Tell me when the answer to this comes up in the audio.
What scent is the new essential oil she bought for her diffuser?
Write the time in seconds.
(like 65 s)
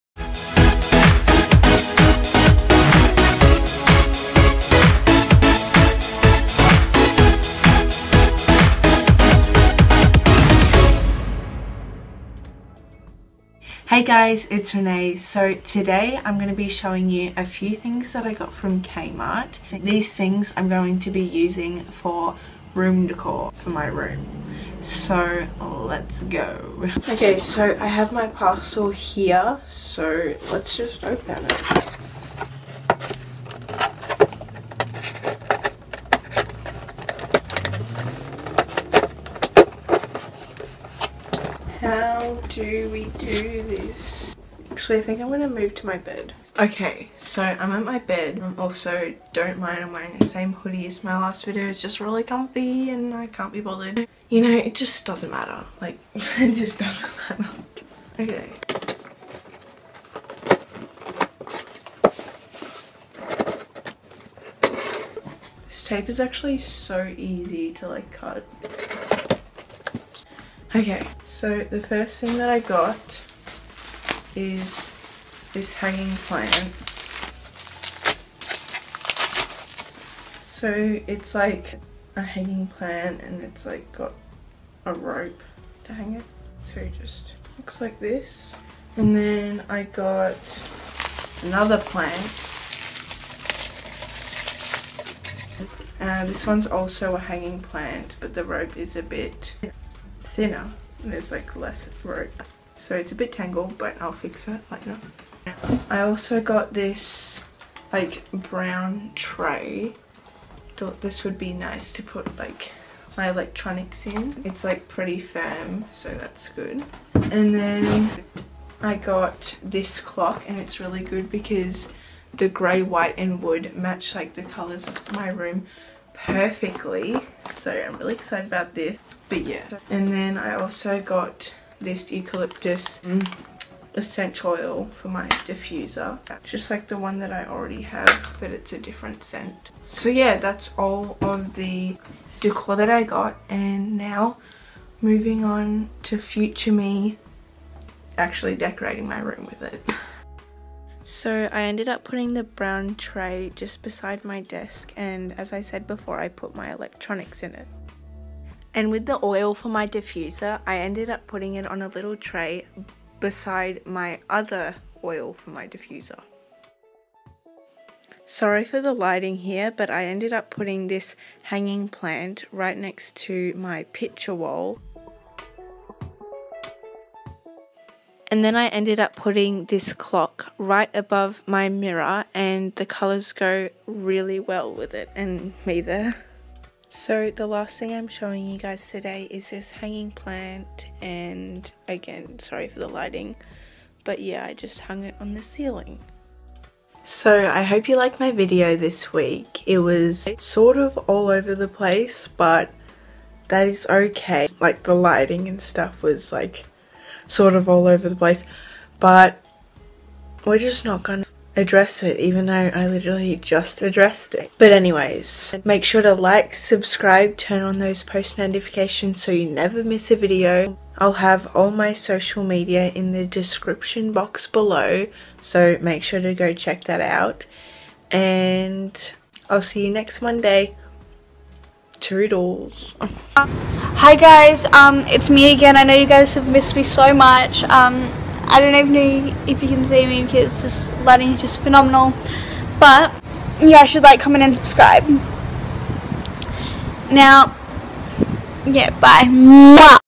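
132 s.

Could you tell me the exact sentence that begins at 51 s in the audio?
It's just really comfy and I can't be bothered.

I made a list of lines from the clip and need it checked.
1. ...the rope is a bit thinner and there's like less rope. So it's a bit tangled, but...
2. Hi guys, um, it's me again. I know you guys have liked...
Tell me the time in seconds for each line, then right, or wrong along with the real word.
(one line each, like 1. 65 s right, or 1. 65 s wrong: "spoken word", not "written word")
1. 98 s right
2. 233 s wrong: "missed", not "liked".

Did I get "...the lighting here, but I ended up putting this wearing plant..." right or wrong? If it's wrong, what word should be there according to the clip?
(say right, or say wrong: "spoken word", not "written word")
wrong: "hanging", not "wearing".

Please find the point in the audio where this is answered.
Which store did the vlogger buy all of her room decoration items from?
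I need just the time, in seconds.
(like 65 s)
18 s.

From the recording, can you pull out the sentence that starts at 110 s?
Thought this would be nice to put like my electronics in.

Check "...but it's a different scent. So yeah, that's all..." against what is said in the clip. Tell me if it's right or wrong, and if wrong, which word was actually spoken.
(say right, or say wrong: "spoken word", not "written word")
right.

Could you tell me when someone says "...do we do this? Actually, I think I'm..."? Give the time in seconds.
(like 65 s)
42 s.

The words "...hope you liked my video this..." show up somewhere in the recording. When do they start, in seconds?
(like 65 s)
197 s.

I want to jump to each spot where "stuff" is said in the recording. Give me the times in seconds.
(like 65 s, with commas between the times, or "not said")
205 s.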